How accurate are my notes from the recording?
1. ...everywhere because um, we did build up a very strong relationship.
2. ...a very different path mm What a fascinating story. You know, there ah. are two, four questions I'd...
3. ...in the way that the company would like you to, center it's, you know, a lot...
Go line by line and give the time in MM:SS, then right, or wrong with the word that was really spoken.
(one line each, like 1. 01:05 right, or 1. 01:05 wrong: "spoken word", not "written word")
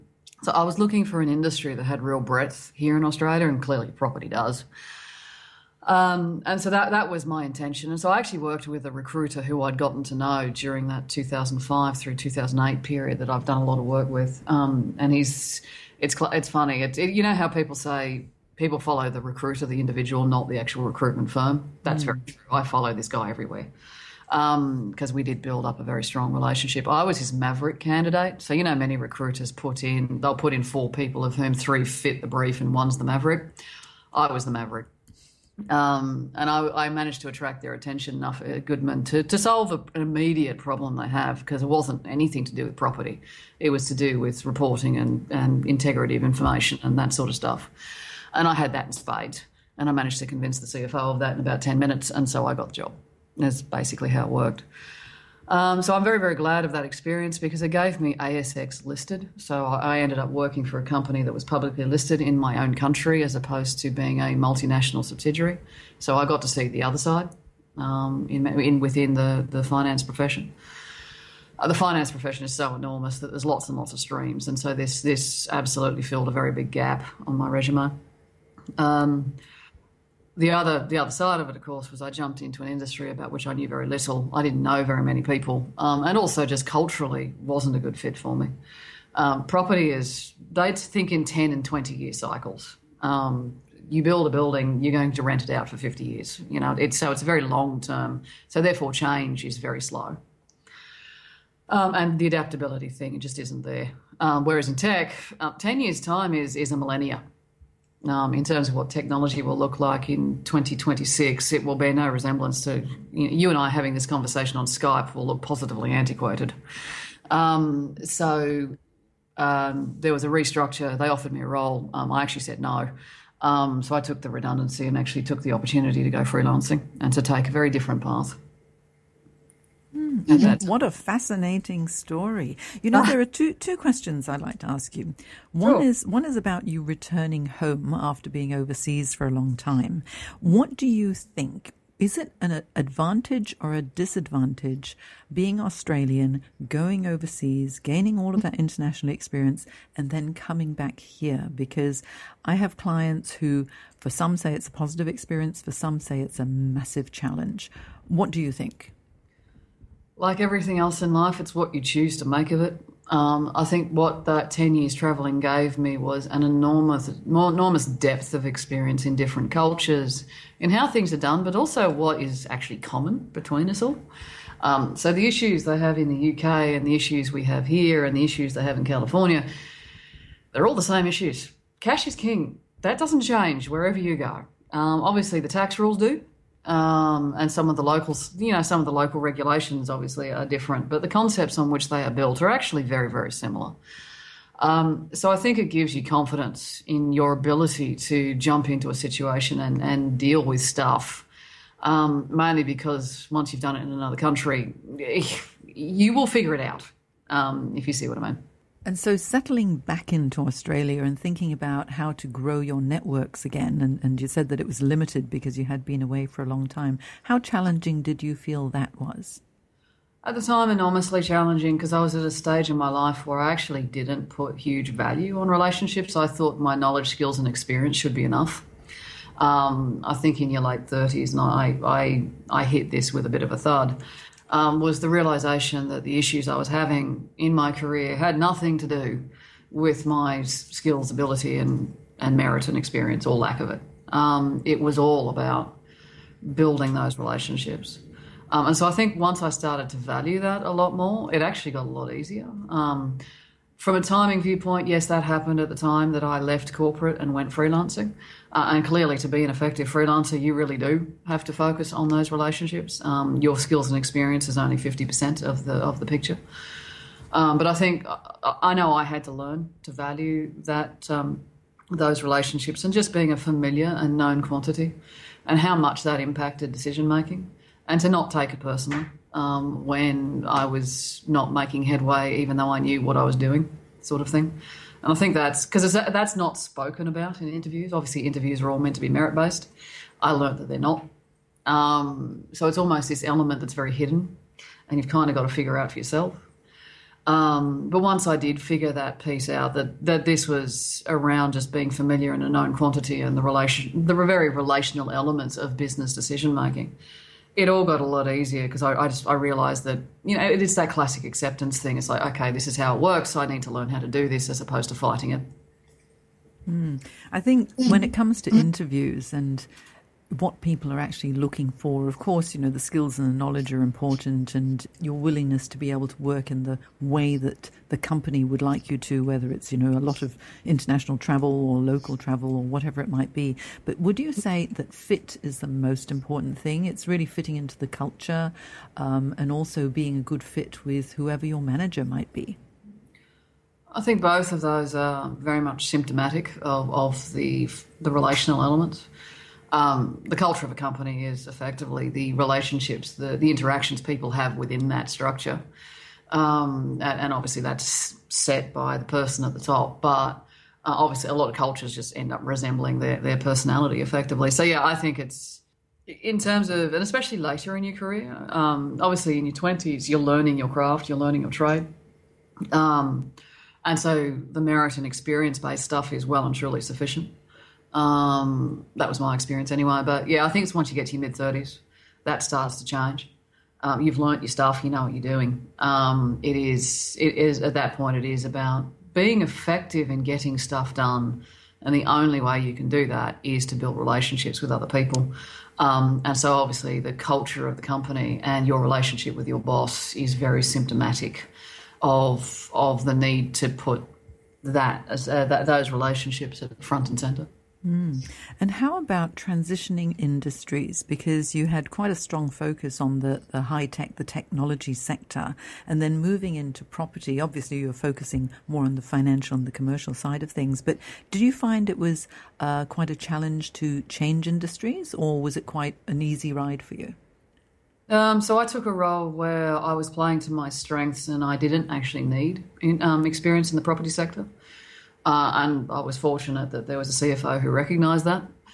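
1. 00:23 right
2. 02:07 wrong: "two", not "four"
3. 05:26 wrong: "whether", not "center".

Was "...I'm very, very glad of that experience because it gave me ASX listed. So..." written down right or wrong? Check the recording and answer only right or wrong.
right.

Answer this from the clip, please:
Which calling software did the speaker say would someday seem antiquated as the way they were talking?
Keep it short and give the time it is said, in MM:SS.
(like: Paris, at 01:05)
Skype, at 01:54.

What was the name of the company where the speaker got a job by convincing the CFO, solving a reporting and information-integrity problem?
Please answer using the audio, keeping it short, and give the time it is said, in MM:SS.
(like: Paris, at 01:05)
Goodman, at 00:38.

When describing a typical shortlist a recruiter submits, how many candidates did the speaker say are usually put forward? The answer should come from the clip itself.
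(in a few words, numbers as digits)
4.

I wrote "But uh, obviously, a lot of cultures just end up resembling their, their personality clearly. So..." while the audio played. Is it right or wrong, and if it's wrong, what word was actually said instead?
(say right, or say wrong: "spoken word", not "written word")
wrong: "effectively", not "clearly".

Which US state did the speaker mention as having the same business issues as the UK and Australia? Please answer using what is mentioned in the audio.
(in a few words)
California.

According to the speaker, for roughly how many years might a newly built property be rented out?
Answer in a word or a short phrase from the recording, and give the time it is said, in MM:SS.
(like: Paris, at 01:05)
50 years, at 01:35.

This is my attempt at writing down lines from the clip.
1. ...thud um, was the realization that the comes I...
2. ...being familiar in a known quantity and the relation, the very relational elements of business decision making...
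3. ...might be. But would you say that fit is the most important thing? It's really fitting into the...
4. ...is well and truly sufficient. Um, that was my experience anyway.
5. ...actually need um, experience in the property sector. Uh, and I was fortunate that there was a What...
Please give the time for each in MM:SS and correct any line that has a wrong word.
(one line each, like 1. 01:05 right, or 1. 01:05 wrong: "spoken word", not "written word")
1. 03:53 wrong: "issues", not "comes"
2. 05:01 right
3. 05:33 right
4. 06:16 right
5. 07:11 wrong: "CFO", not "What".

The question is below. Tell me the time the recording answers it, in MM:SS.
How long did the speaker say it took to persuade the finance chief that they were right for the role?
00:51.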